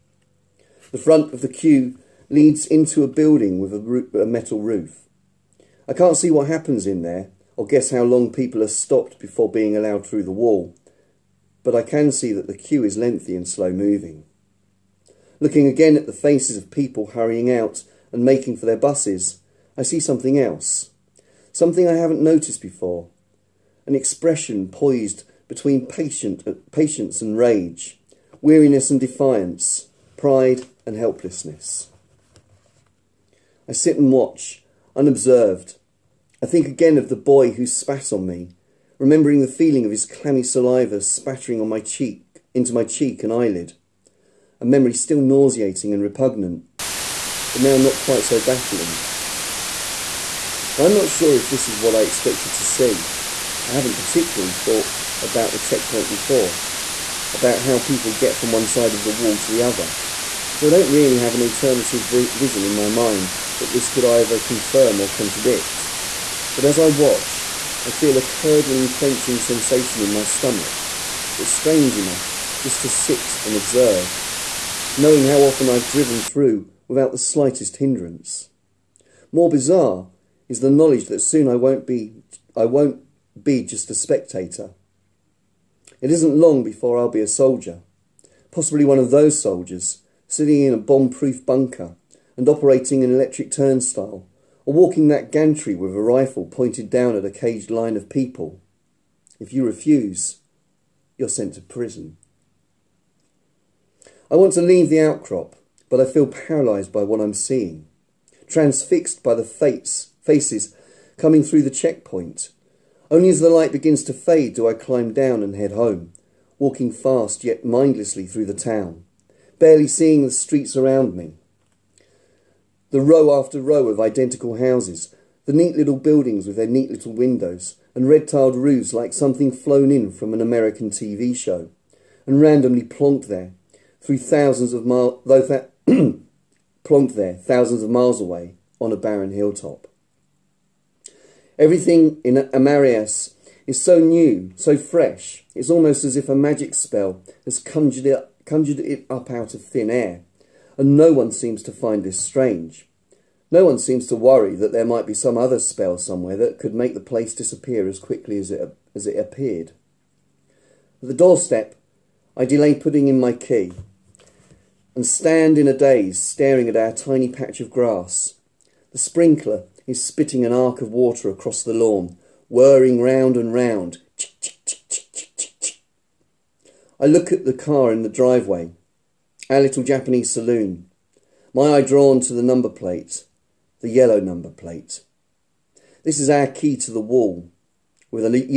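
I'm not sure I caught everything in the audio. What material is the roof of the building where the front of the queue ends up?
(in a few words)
Metal.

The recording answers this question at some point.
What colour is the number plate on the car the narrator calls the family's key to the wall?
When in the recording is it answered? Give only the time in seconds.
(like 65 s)
183 s.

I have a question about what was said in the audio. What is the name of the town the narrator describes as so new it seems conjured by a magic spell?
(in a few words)
Amarius.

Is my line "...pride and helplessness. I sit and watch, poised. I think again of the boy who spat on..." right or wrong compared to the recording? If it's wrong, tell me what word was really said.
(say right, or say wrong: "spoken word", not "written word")
wrong: "unobserved", not "poised".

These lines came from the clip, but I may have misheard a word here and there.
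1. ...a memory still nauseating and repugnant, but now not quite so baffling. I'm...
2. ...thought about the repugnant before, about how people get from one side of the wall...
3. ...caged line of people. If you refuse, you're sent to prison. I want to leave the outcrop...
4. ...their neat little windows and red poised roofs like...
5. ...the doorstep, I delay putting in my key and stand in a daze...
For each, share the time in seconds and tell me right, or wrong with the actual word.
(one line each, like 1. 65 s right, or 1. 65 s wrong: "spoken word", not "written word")
1. 44 s right
2. 54 s wrong: "checkpoint", not "repugnant"
3. 97 s right
4. 126 s wrong: "tiled", not "poised"
5. 161 s right.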